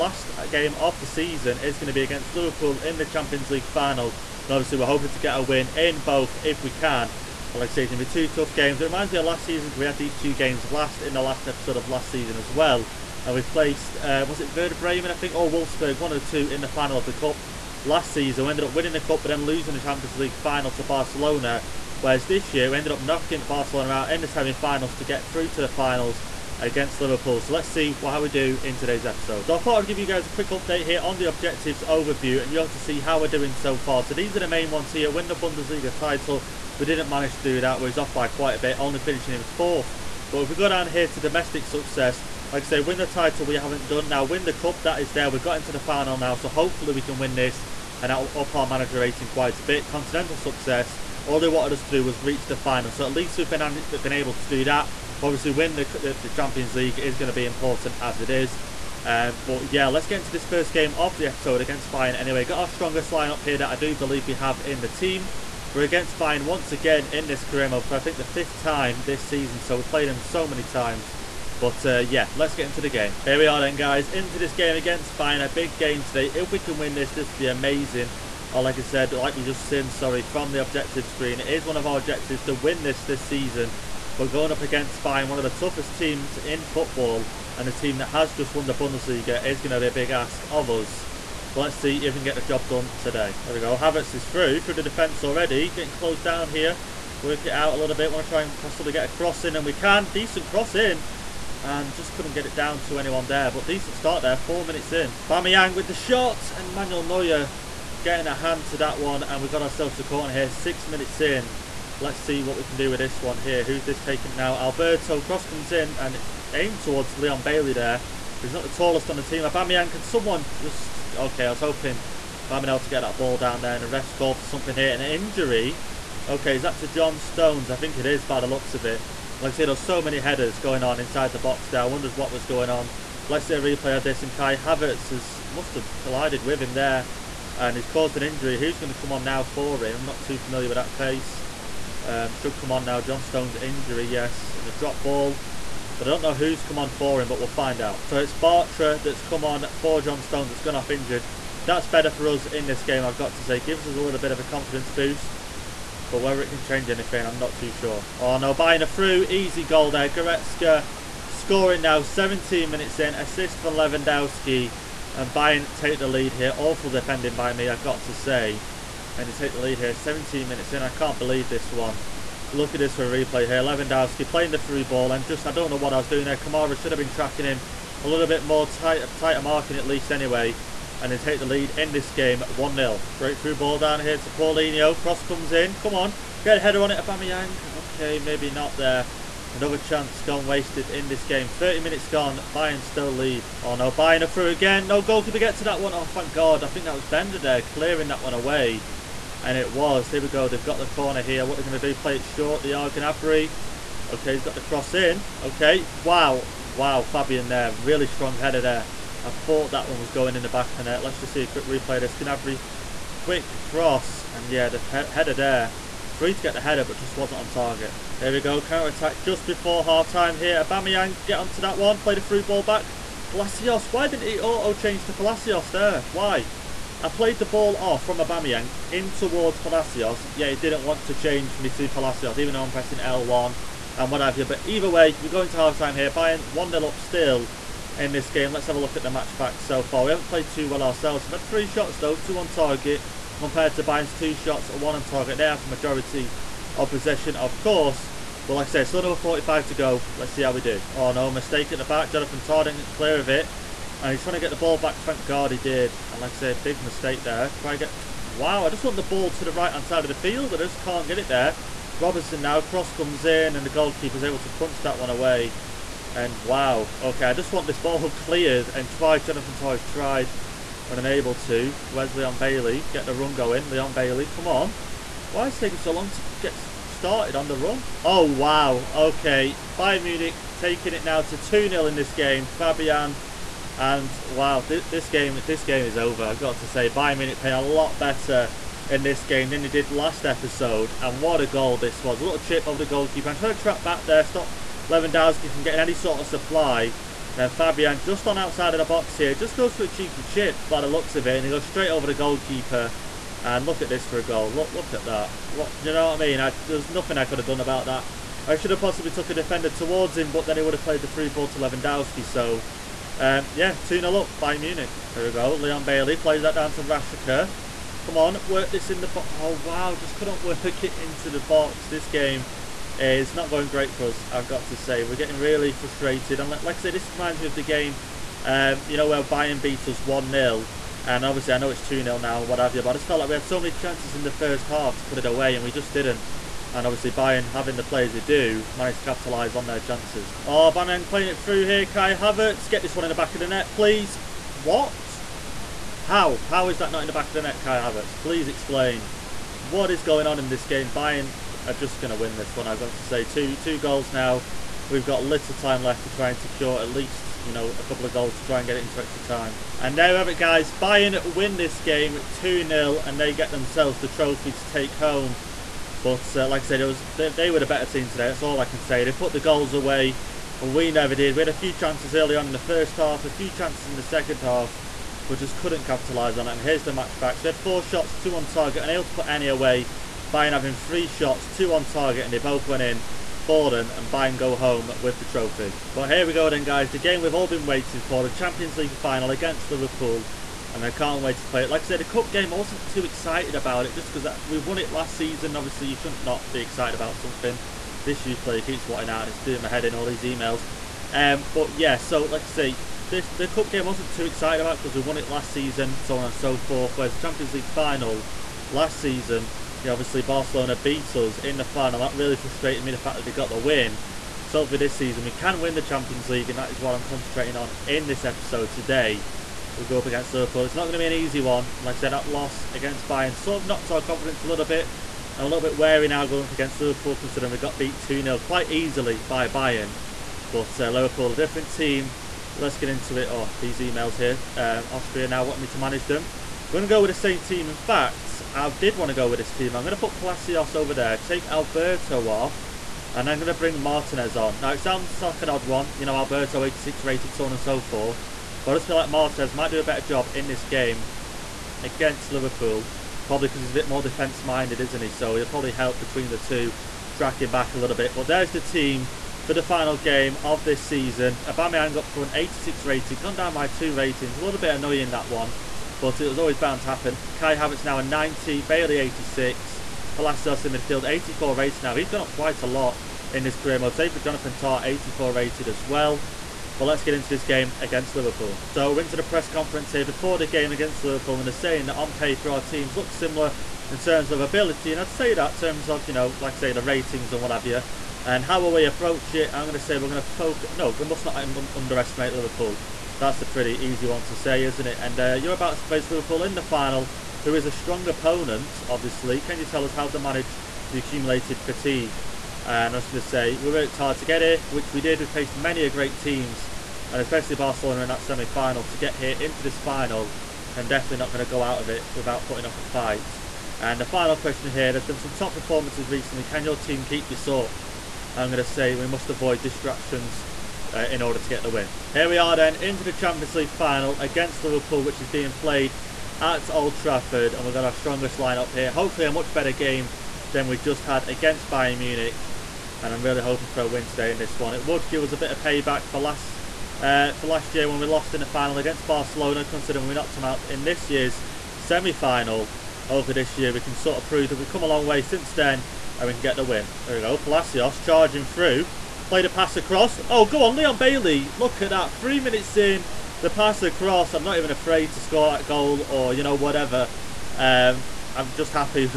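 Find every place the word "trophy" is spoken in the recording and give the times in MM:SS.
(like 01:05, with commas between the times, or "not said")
06:04, 06:25.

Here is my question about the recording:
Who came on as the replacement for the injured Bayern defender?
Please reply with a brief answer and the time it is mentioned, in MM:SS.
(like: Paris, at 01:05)
Bartra, at 02:28.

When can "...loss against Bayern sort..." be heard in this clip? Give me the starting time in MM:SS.
07:02.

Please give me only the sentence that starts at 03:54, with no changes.
But either way, we're going to half-time here.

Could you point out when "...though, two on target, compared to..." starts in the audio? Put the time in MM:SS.
04:01.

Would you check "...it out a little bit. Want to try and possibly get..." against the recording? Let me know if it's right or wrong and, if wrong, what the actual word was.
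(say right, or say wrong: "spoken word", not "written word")
right.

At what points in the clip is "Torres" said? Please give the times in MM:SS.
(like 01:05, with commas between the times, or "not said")
04:29.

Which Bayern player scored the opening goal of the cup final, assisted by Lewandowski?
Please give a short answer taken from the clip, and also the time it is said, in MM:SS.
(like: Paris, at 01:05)
Goretzka, at 02:40.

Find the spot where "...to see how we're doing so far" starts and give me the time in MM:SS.
00:32.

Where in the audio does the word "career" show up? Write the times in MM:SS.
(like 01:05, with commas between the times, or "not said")
01:07, 07:53.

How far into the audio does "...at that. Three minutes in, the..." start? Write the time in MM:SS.
09:11.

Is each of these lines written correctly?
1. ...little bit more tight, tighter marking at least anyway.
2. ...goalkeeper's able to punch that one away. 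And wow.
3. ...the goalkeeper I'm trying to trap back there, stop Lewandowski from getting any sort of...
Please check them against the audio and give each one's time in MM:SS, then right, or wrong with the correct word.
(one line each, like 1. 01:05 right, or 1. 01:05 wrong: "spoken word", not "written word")
1. 02:58 right
2. 04:23 right
3. 04:52 right.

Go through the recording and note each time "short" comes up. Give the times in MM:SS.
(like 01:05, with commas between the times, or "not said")
03:22.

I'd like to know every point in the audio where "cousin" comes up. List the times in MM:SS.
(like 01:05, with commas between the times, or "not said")
not said.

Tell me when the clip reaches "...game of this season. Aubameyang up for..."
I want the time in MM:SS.
07:39.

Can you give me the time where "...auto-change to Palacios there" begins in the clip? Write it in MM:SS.
03:44.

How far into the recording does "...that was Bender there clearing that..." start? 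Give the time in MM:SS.
03:16.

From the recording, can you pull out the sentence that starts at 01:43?
But decent start there, four minutes in.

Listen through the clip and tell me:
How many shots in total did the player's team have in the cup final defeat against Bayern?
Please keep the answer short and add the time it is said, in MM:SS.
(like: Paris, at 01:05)
4, at 06:17.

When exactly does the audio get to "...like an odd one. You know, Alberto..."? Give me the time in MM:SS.
07:25.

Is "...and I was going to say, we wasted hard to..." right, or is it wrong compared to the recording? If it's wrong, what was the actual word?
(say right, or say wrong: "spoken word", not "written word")
wrong: "worked", not "wasted".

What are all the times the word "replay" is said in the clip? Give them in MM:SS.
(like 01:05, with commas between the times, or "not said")
02:13, 02:53, 03:31.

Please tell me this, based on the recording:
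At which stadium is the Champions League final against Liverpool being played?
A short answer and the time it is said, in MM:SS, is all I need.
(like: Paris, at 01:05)
Old Trafford, at 08:46.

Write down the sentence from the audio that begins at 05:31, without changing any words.
And obviously, I know it's 2-0 now Whatever, what have you.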